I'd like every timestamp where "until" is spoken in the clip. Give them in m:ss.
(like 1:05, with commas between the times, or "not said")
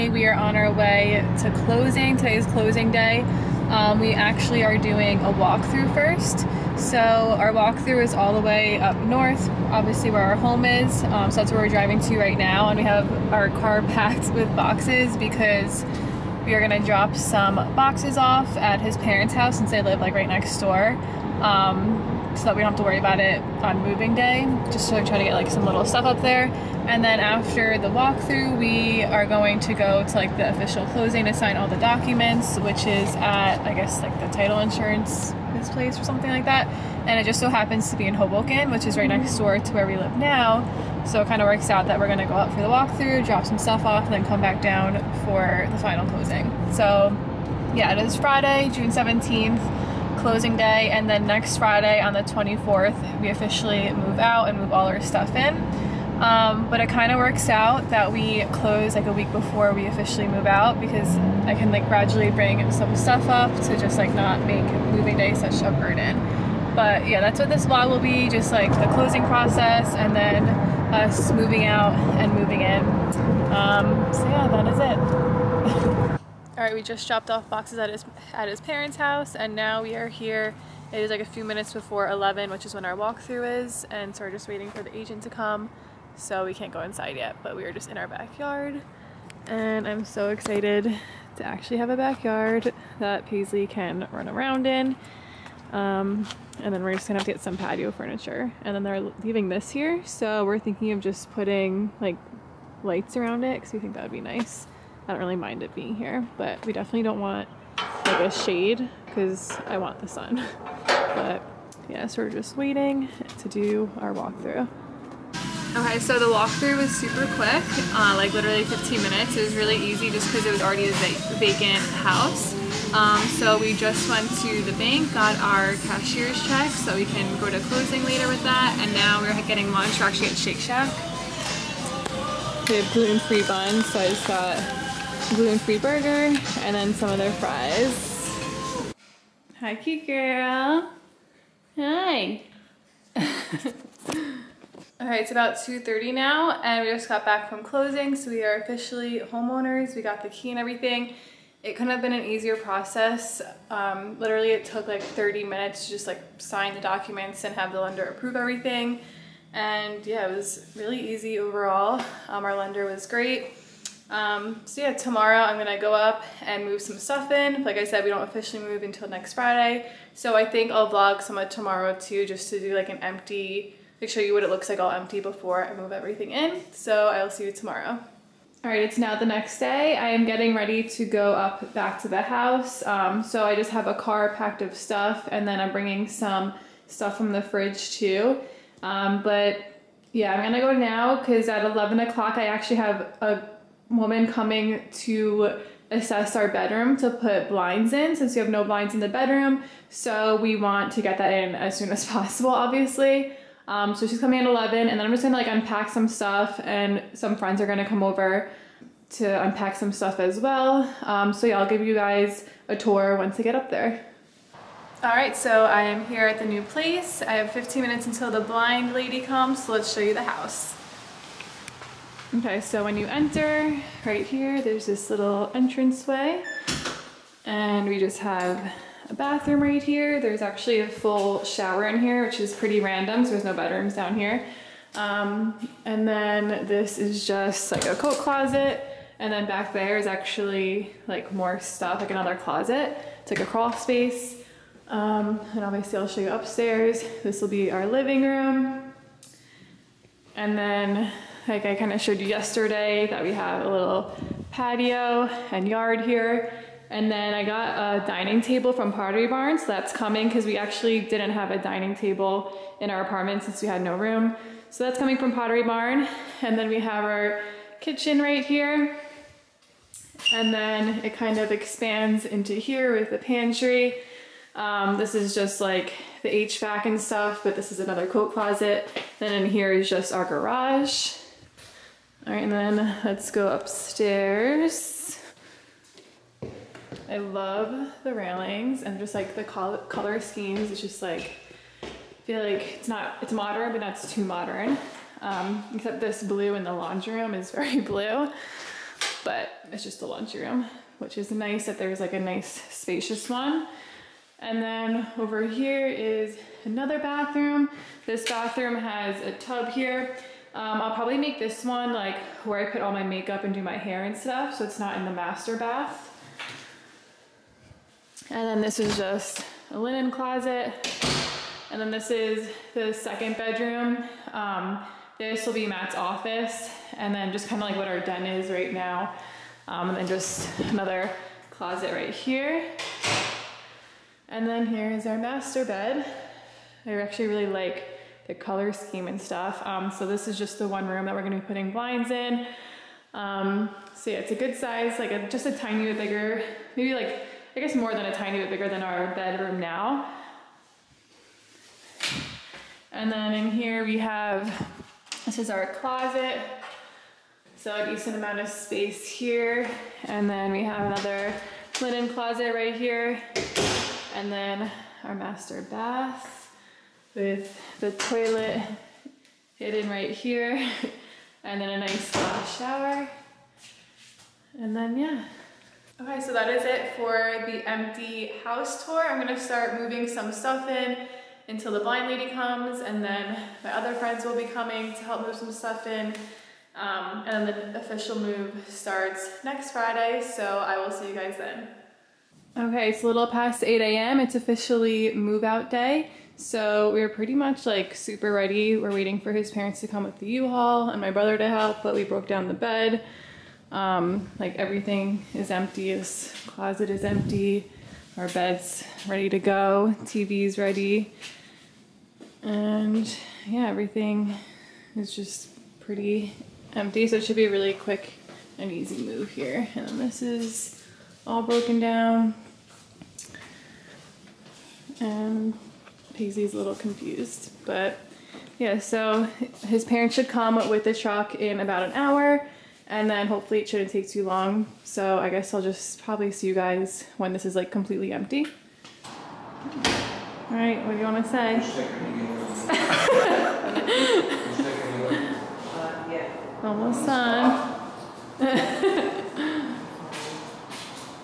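2:48, 3:38, 6:21.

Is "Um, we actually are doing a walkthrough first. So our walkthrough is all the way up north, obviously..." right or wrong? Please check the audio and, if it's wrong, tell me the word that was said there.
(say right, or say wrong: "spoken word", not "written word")
right.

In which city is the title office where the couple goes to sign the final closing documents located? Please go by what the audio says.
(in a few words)
Hoboken.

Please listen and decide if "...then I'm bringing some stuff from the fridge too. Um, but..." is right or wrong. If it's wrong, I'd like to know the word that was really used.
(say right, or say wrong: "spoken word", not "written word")
right.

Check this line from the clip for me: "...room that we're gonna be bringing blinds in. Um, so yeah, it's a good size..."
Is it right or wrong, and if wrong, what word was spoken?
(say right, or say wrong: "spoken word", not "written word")
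wrong: "putting", not "bringing".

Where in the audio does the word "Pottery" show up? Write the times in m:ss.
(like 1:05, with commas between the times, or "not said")
4:18, 4:25.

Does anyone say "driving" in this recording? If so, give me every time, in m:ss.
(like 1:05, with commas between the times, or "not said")
0:11.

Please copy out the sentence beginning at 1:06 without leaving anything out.
But yeah, that's what this vlog will be just like the closing process and then us moving out and moving in.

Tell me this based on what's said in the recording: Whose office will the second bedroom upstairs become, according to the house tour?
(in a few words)
Matt.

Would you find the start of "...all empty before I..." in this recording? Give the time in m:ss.
2:54.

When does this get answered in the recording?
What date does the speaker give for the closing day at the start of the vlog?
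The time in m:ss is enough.
0:48.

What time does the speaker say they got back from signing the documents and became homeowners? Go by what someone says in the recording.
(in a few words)
2:30.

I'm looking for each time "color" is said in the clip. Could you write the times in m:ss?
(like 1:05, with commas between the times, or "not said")
4:49, 5:38.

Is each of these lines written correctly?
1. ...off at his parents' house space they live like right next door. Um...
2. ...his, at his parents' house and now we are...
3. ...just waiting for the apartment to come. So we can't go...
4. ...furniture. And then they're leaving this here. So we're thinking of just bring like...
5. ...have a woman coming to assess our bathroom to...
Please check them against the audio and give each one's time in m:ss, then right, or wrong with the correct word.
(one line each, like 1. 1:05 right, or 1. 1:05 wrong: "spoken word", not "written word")
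1. 0:18 wrong: "since", not "space"
2. 1:17 right
3. 1:24 wrong: "agent", not "apartment"
4. 1:37 wrong: "putting", not "bring"
5. 3:12 wrong: "bedroom", not "bathroom".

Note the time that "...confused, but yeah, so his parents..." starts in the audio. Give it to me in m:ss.
7:06.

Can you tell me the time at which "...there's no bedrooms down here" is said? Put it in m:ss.
3:53.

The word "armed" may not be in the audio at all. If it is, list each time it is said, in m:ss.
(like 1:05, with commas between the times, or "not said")
not said.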